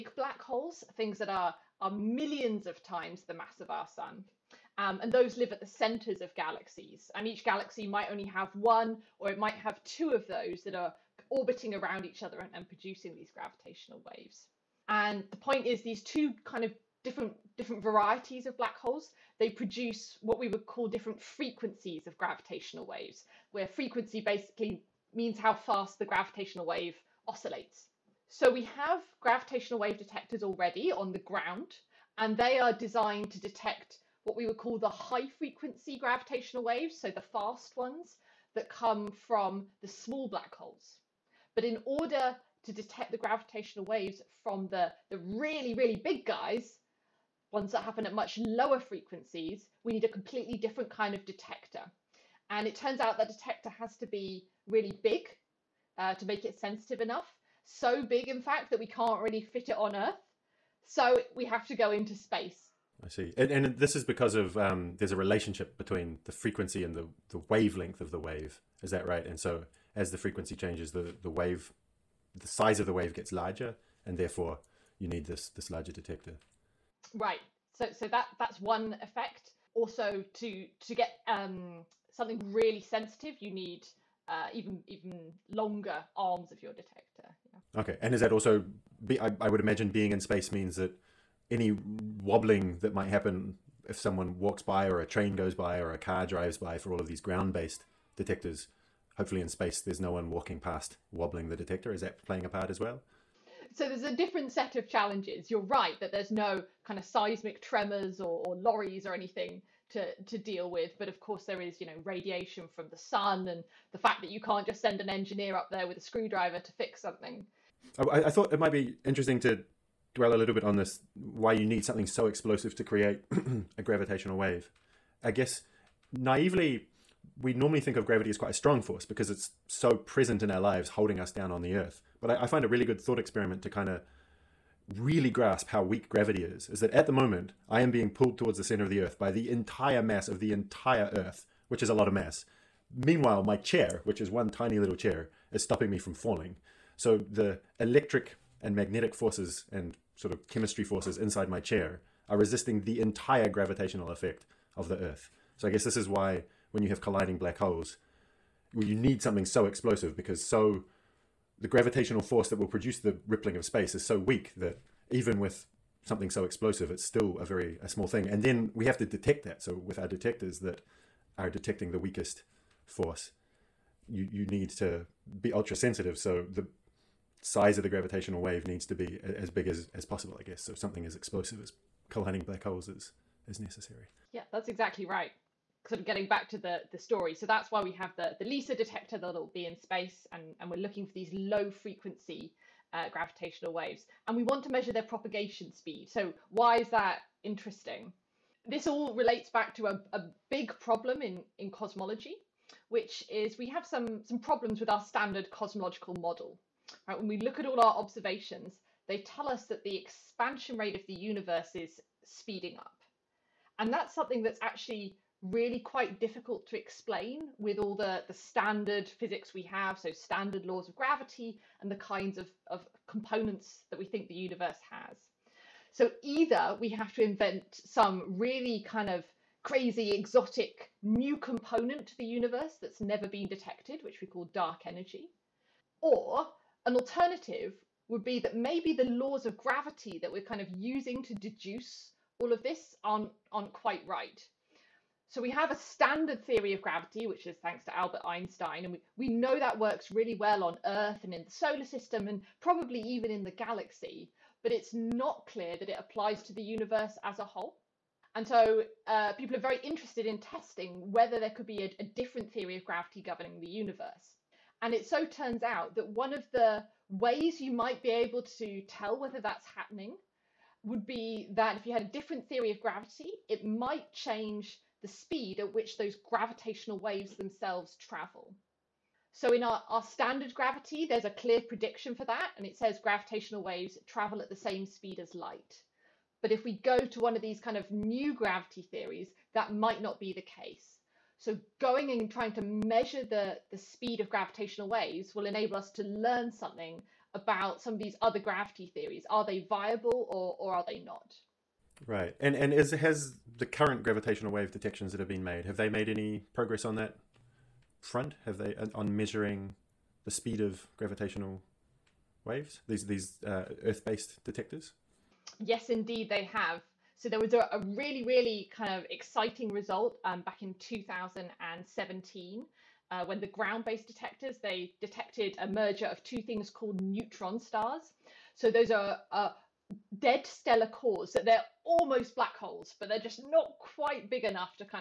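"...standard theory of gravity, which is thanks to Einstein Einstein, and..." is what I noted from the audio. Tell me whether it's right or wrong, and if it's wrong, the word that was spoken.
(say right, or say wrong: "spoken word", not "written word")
wrong: "Albert", not "Einstein".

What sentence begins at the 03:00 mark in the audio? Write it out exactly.
So something as explosive as colliding black holes is, is necessary.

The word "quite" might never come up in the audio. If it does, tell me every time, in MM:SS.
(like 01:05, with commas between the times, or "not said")
02:08, 03:35, 04:03, 05:33.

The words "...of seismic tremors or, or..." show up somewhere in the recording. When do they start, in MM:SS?
01:46.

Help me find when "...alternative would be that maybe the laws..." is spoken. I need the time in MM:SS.
03:56.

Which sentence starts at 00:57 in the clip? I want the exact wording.
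So big, in fact, that we can't really fit it on Earth.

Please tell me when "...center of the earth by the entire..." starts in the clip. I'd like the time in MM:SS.
02:18.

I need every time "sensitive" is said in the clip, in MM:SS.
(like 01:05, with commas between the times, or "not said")
00:56, 01:22, 02:55.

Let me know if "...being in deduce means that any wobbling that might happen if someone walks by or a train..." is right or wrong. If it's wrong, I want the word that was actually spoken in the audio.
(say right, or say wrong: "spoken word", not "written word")
wrong: "space", not "deduce".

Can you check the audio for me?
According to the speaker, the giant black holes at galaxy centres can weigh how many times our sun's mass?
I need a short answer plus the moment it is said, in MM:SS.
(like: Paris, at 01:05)
millions, at 00:01.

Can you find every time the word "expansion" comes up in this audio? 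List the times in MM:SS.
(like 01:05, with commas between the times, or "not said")
03:29.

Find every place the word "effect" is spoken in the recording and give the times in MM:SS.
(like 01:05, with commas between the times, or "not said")
01:19, 02:34.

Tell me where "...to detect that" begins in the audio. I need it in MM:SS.
02:48.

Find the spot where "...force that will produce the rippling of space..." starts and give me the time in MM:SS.
02:42.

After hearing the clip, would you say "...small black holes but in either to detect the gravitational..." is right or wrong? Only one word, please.
wrong.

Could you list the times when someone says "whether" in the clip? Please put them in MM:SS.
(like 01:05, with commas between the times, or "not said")
04:21, 04:29.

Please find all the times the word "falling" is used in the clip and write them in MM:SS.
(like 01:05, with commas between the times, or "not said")
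02:26.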